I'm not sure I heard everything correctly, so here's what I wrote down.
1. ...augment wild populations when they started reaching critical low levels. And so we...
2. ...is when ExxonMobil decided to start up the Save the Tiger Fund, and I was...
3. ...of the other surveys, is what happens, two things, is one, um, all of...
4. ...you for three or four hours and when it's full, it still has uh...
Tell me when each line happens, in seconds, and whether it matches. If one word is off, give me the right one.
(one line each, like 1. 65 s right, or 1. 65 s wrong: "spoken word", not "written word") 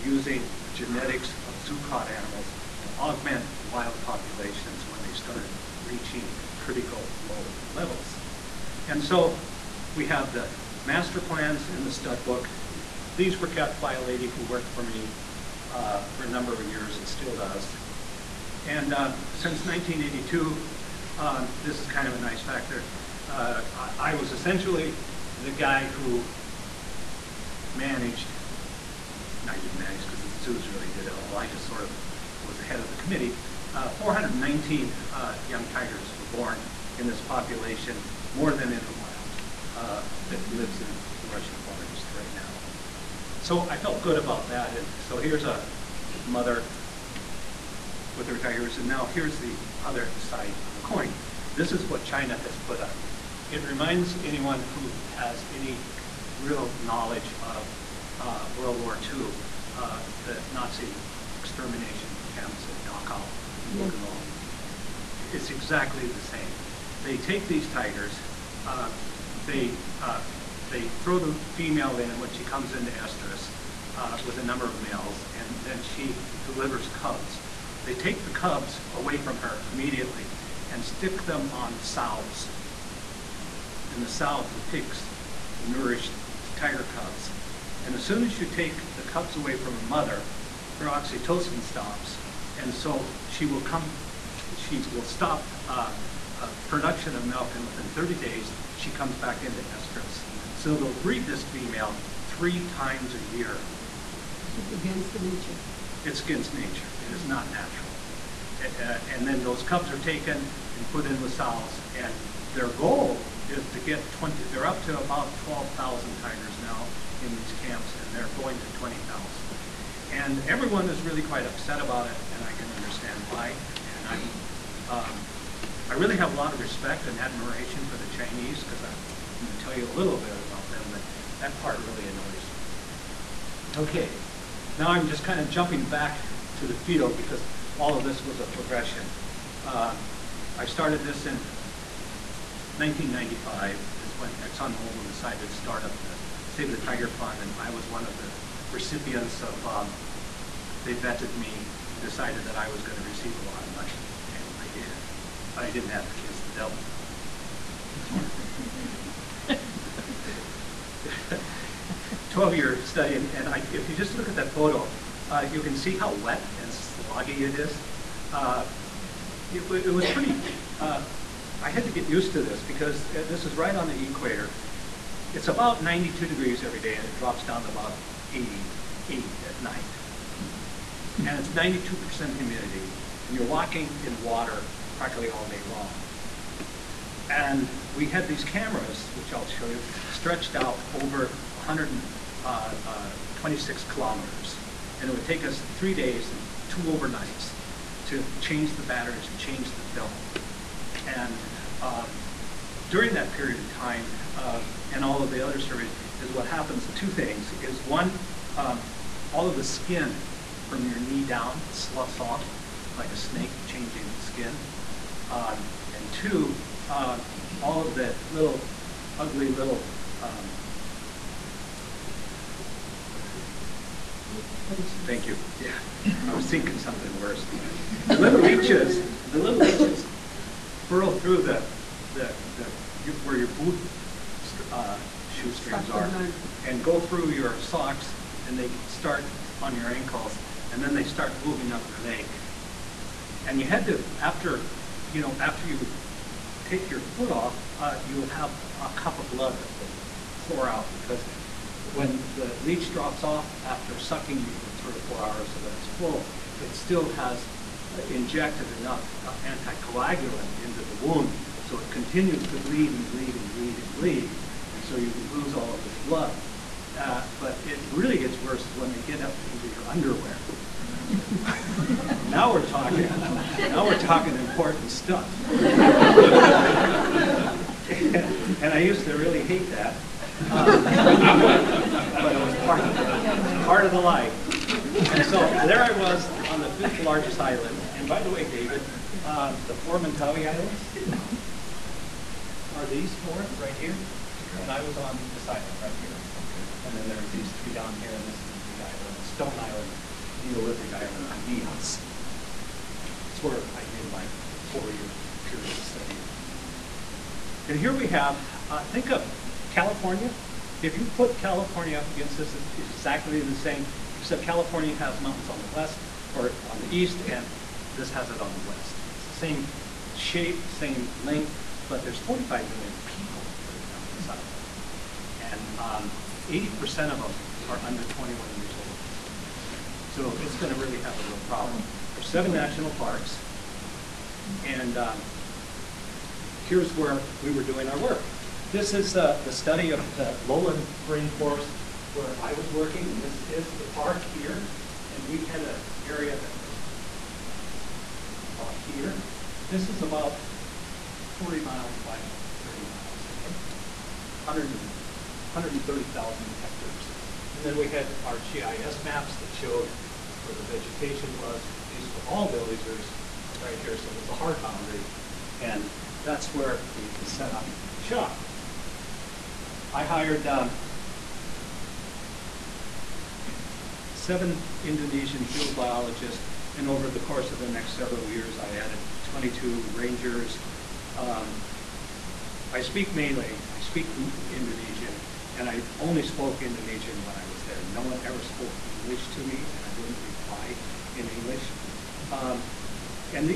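1. 2 s right
2. 144 s right
3. 205 s right
4. 254 s right.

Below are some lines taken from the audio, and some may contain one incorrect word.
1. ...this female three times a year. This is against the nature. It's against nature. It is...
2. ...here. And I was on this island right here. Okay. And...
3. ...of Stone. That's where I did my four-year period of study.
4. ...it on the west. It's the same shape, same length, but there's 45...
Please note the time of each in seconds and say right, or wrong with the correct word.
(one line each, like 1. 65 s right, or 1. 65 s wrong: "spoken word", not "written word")
1. 101 s right
2. 293 s right
3. 301 s wrong: "Nias", not "Stone"
4. 318 s right.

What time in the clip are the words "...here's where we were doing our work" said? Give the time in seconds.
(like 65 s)
336 s.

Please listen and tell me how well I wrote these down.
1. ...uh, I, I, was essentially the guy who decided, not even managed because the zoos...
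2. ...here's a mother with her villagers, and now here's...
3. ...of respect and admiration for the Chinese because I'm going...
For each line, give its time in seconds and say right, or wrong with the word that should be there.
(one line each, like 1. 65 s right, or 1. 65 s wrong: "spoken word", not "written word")
1. 23 s wrong: "managed", not "decided"
2. 45 s wrong: "tigers", not "villagers"
3. 126 s right.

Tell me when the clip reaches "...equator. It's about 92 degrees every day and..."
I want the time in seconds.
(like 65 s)
174 s.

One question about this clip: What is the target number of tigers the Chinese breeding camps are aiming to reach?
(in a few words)
20,000.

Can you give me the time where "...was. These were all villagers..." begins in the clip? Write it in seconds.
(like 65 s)
361 s.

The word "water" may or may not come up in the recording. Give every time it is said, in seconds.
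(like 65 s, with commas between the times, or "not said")
184 s.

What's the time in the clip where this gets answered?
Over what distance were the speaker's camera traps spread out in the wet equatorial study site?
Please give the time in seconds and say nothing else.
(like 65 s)
191 s.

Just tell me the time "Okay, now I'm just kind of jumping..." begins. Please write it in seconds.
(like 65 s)
133 s.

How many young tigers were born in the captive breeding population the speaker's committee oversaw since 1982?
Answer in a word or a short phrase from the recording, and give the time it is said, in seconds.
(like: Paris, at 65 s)
419, at 33 s.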